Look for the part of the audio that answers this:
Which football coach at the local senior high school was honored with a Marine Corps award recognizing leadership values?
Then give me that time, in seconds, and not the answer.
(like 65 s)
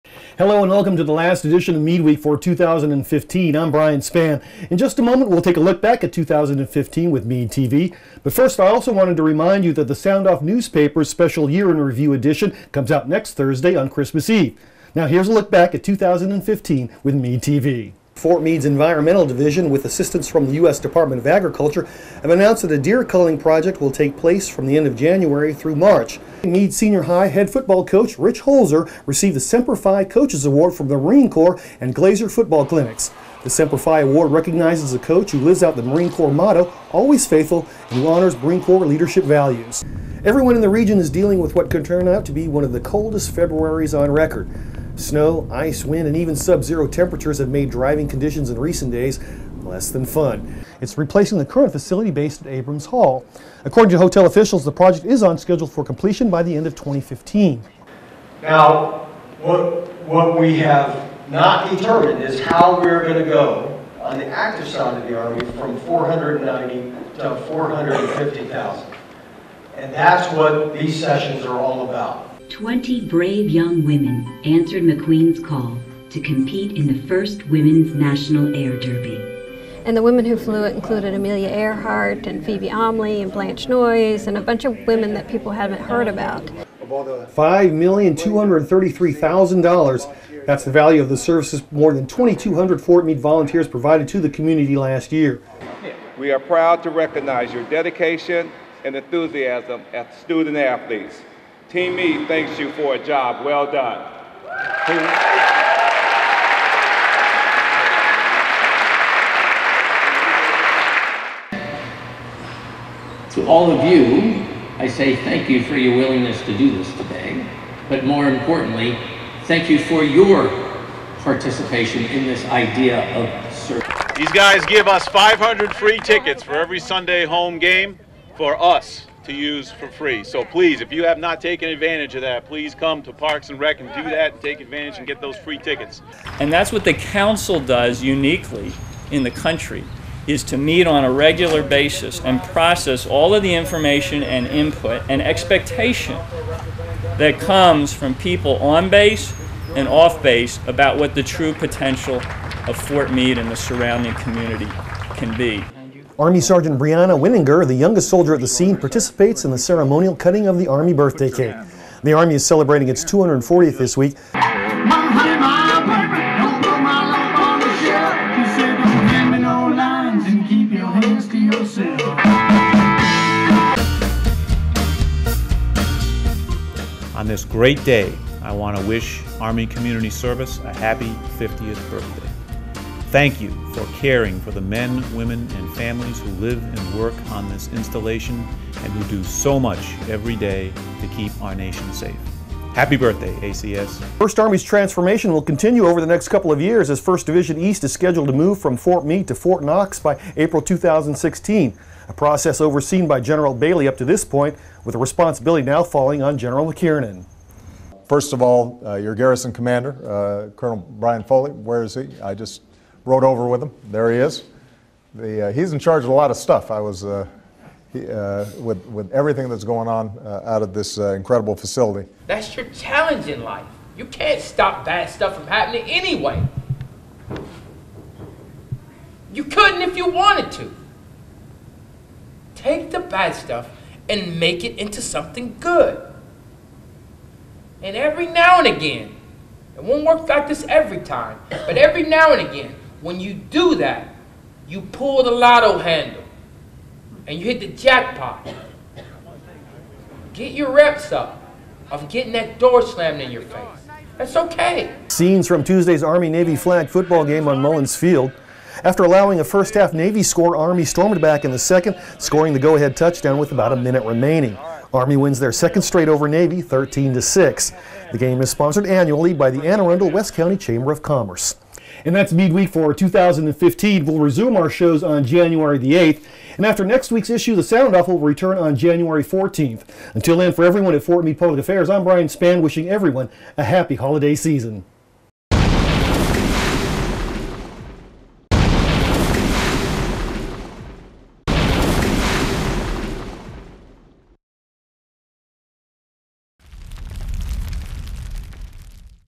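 28 s.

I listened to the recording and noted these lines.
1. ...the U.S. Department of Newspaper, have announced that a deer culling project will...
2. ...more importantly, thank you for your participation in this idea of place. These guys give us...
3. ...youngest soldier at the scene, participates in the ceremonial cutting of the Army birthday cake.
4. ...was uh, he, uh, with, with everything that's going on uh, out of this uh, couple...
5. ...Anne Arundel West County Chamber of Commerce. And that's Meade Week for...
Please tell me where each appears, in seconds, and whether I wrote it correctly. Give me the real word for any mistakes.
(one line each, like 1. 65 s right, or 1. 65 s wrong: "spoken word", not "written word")
1. 20 s wrong: "Agriculture", not "Newspaper"
2. 118 s wrong: "service", not "place"
3. 157 s right
4. 216 s wrong: "incredible", not "couple"
5. 269 s right.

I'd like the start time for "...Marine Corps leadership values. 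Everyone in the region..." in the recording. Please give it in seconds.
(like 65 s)
38 s.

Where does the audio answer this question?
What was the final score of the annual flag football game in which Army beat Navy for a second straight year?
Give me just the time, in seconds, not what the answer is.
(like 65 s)
266 s.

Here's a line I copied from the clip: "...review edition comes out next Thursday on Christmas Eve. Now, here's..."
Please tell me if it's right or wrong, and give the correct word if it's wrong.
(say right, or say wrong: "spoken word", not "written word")
right.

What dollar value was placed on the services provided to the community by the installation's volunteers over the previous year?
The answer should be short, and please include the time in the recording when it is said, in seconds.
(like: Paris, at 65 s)
$5,233,000, at 86 s.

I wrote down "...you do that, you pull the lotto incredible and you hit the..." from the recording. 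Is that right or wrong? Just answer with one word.
wrong.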